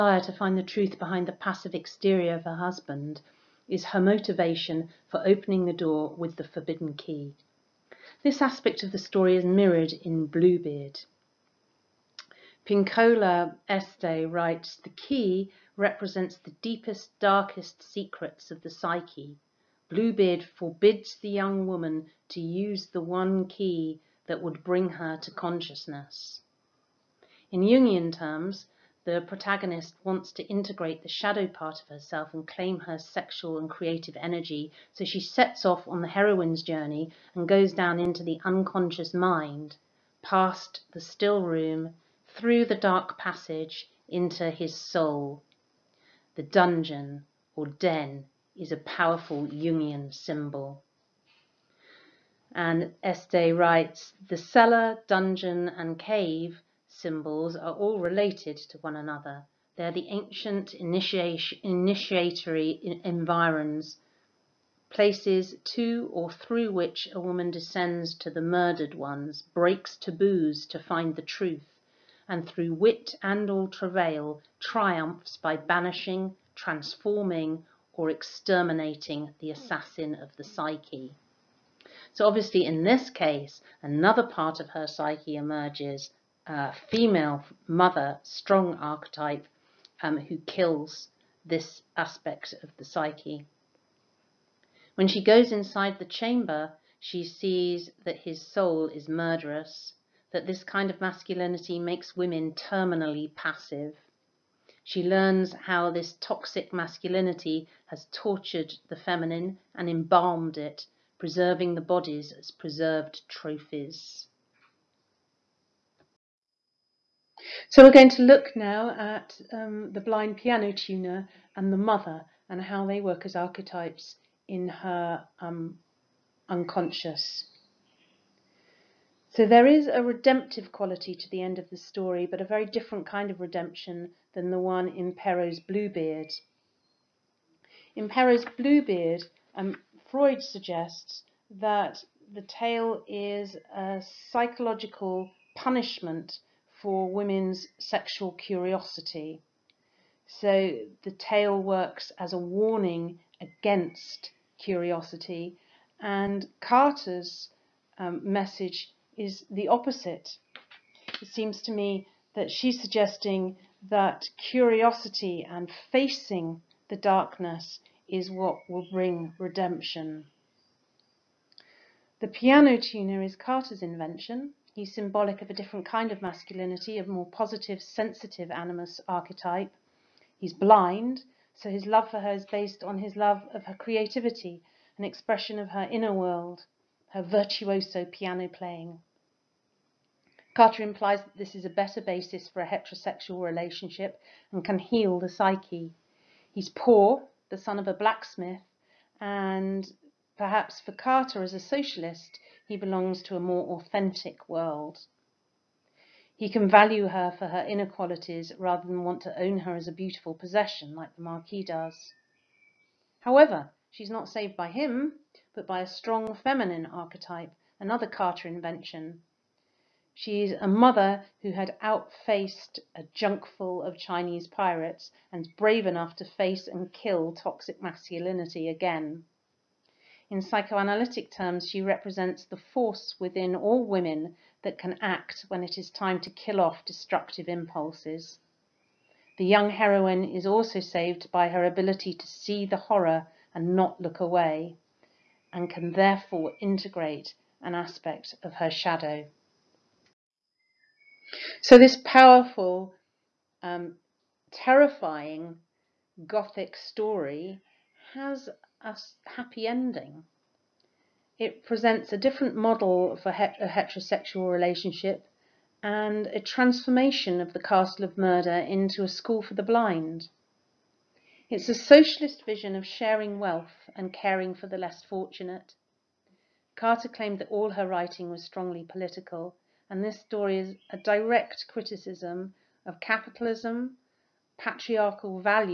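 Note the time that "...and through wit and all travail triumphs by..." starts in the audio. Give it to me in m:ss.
1:12.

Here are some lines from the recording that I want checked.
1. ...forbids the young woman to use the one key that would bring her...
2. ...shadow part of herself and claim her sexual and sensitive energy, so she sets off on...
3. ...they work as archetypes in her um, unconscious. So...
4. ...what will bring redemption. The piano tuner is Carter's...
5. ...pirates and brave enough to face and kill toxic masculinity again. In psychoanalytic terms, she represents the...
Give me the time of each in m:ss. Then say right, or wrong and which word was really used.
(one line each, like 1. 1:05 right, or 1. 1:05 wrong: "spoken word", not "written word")
1. 0:20 right
2. 0:31 wrong: "creative", not "sensitive"
3. 2:02 right
4. 2:48 right
5. 3:44 right.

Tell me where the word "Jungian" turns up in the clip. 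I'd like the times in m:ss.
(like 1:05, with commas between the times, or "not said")
0:27, 0:49.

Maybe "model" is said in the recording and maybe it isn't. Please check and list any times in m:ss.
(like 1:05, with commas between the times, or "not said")
4:22.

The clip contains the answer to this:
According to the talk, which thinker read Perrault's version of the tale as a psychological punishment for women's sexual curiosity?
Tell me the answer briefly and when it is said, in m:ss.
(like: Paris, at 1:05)
Freud, at 2:20.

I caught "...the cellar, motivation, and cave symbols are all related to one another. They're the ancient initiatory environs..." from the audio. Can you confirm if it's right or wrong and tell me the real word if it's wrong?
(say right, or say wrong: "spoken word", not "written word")
wrong: "dungeon", not "motivation".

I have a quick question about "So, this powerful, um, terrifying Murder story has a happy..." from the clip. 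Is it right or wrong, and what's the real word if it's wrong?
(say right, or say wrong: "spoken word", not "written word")
wrong: "Gothic", not "Murder".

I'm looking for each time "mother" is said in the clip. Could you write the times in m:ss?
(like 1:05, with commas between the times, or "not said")
1:27, 2:01, 3:40.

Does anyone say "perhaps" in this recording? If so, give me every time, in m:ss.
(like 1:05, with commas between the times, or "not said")
3:20.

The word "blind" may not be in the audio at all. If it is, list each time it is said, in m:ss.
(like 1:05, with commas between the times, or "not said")
1:59, 3:00, 4:29.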